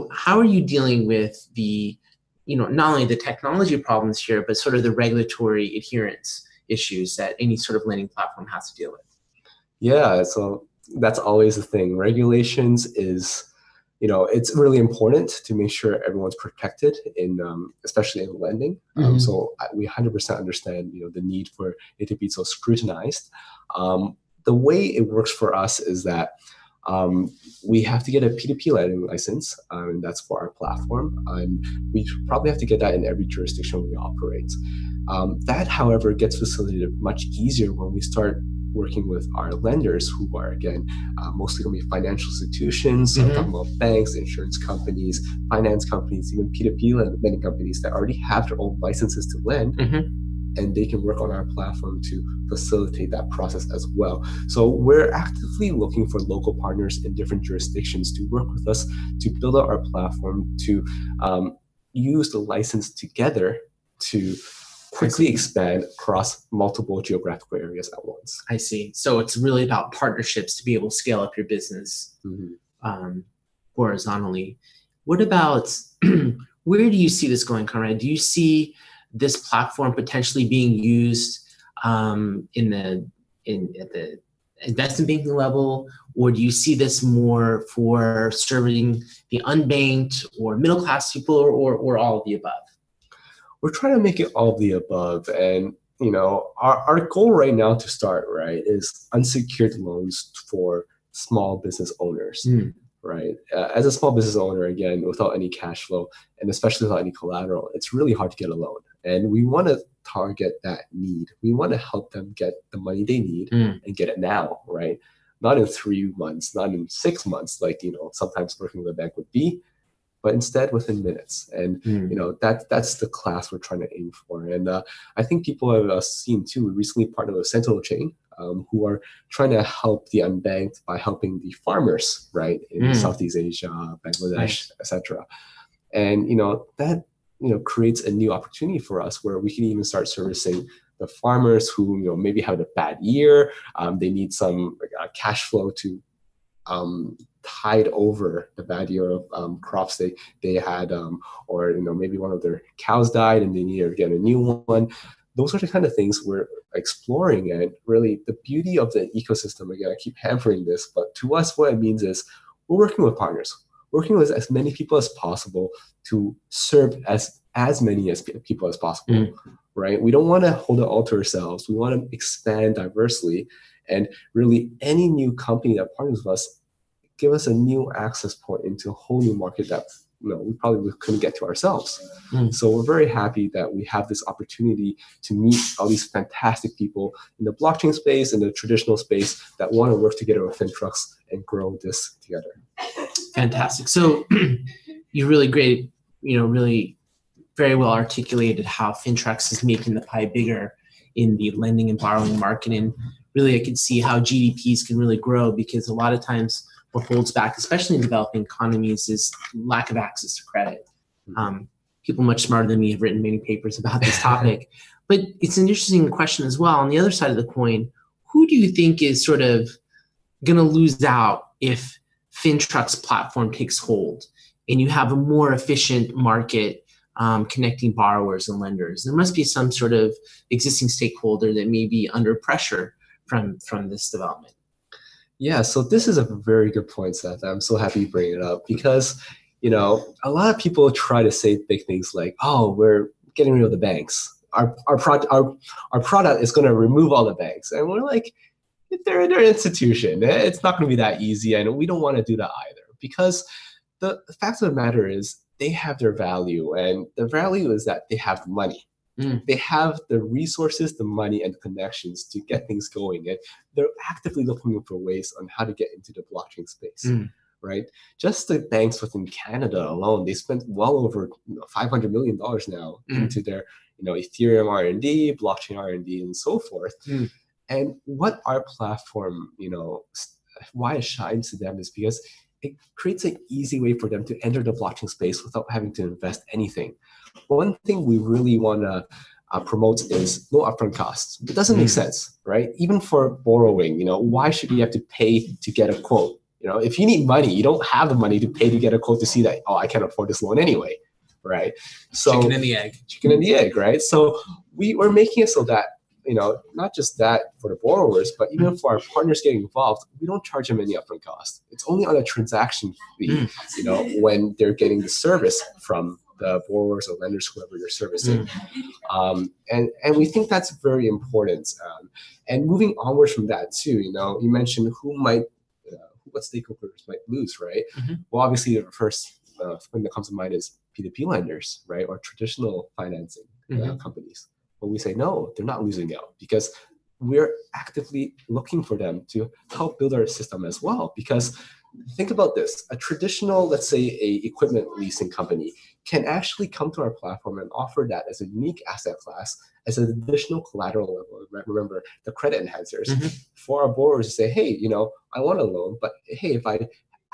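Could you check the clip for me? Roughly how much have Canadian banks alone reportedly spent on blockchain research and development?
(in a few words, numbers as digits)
over $500 million.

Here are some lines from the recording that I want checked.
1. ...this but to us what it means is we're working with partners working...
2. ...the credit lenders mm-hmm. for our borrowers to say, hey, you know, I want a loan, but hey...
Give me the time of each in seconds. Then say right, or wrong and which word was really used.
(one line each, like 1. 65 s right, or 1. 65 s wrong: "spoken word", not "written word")
1. 160 s right
2. 352 s wrong: "enhancers", not "lenders".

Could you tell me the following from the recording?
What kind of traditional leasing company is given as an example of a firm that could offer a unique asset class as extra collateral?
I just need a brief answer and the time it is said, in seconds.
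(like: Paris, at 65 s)
equipment leasing company, at 344 s.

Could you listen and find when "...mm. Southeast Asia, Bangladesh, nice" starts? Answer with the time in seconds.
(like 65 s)
132 s.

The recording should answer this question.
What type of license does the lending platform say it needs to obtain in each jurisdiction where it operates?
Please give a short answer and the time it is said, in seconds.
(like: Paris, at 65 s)
P2P lending license, at 28 s.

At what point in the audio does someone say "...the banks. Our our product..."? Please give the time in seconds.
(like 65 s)
243 s.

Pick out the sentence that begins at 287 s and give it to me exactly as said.
One thing we really want to uh, promote is no upfront costs.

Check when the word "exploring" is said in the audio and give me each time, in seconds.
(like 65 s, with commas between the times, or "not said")
156 s.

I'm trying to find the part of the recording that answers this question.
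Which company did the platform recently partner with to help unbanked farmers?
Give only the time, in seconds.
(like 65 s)
127 s.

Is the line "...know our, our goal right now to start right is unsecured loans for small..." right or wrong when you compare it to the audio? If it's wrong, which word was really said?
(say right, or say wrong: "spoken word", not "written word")
right.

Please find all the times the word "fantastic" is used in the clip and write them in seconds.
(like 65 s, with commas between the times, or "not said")
186 s, 193 s.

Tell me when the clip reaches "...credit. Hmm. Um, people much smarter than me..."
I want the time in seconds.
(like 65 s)
210 s.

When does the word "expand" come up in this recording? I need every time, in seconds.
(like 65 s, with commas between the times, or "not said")
65 s, 172 s.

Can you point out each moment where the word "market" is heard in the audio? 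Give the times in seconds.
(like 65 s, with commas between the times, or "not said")
179 s, 202 s, 226 s.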